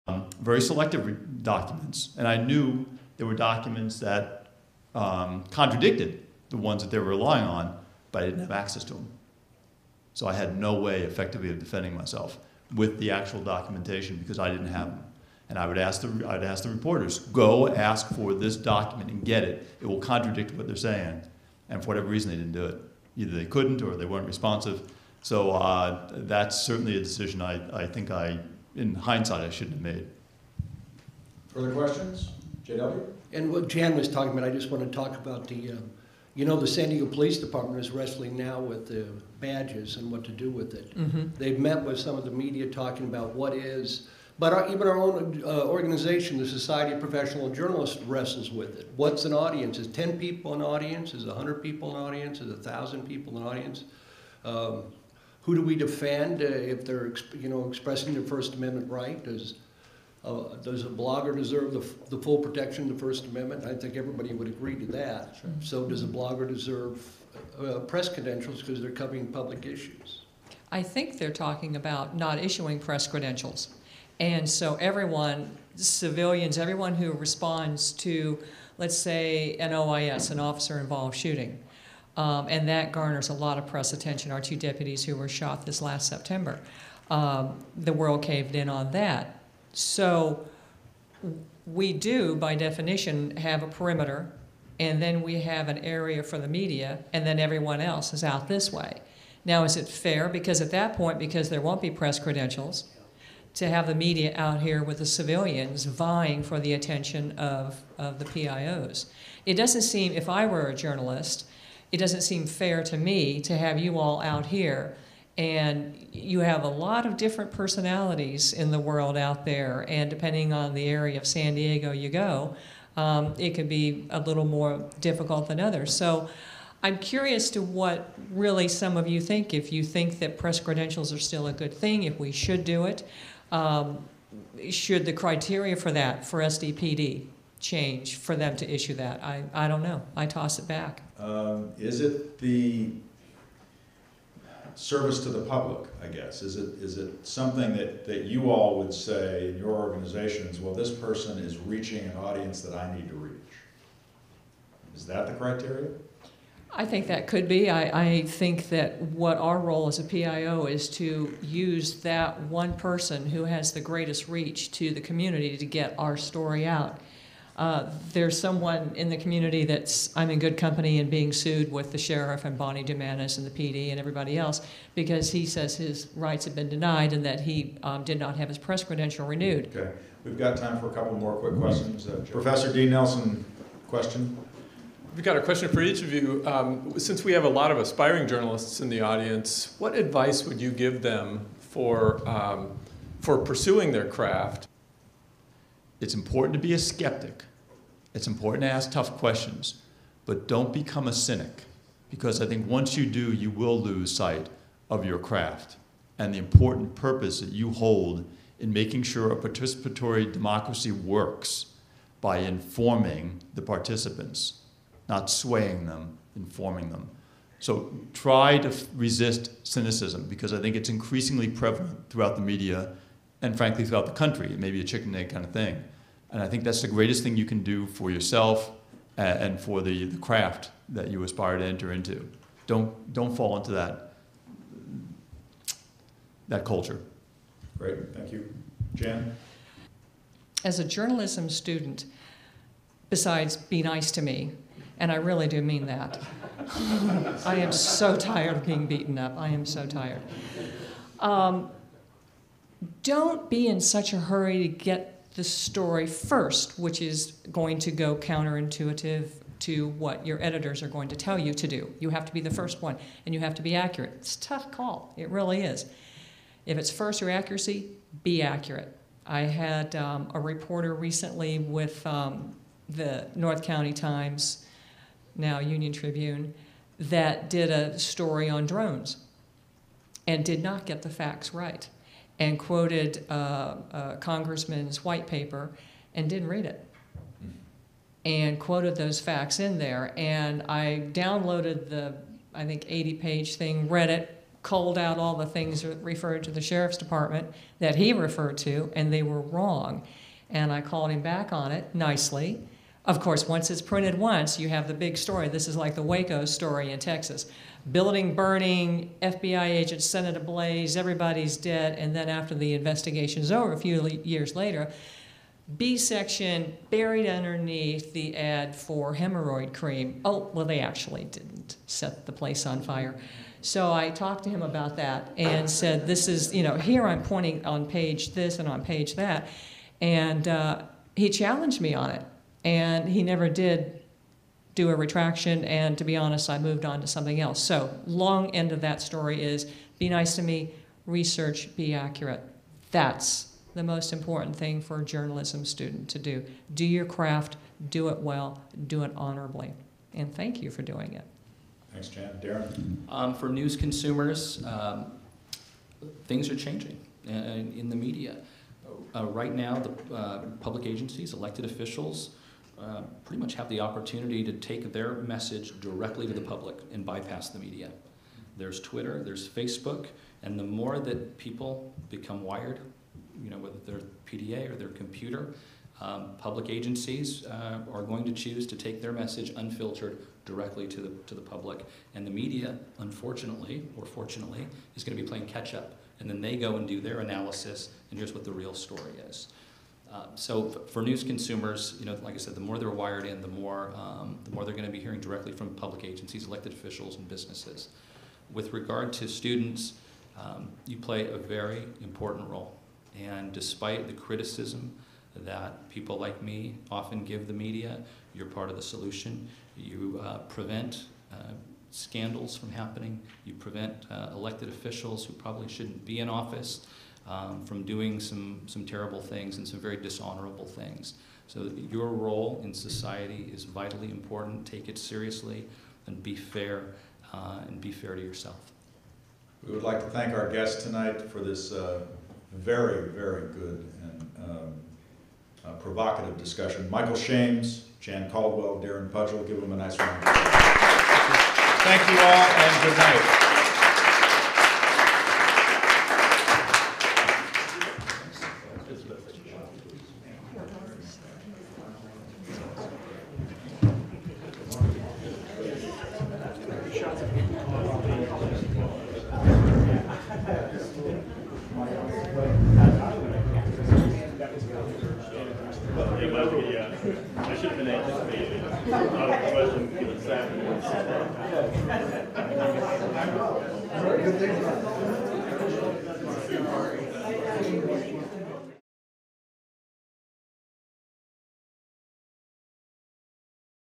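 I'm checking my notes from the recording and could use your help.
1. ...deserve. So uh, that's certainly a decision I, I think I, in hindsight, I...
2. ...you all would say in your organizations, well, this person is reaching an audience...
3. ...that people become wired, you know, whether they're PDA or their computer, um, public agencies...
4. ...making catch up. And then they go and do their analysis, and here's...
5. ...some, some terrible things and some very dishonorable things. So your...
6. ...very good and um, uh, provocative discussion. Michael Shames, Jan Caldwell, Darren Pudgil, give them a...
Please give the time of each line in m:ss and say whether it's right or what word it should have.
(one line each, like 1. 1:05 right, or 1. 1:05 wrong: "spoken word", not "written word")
1. 0:24 wrong: "responsive", not "deserve"
2. 2:28 right
3. 6:10 right
4. 6:25 wrong: "playing", not "making"
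5. 6:58 right
6. 7:13 right.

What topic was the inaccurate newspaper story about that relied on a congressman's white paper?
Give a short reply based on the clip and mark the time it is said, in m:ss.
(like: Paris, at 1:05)
drones, at 4:38.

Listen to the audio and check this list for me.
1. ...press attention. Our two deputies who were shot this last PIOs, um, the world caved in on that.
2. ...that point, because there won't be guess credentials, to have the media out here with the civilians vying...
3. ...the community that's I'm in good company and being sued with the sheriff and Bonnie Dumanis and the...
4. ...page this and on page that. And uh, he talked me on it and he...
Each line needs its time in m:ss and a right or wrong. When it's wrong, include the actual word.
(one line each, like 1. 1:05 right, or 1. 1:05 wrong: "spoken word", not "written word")
1. 1:23 wrong: "September", not "PIOs"
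2. 1:40 wrong: "press", not "guess"
3. 2:49 right
4. 5:27 wrong: "challenged", not "talked".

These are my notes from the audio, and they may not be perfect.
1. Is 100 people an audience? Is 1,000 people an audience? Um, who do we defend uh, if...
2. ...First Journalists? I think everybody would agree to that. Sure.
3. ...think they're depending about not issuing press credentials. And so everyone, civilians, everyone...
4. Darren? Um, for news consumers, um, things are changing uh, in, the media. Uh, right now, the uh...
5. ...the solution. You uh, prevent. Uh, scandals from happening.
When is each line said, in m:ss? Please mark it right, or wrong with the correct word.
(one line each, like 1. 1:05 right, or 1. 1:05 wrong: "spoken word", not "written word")
1. 0:51 right
2. 1:03 wrong: "Amendment", not "Journalists"
3. 1:10 wrong: "talking", not "depending"
4. 5:52 right
5. 6:48 right.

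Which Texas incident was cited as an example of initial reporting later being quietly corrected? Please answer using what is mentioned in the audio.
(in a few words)
Waco.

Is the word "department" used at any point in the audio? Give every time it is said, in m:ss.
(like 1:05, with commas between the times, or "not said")
0:37, 4:56.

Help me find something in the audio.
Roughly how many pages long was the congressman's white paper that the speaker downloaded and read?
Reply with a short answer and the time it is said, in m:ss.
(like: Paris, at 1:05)
80, at 4:52.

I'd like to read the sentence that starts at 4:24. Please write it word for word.
It's a tough call, it really is.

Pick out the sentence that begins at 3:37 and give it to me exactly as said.
So try to resist cynicism because I think it's increasingly prevalent throughout the media and frankly throughout the country.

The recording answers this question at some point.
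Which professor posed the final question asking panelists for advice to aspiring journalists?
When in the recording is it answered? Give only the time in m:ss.
3:02.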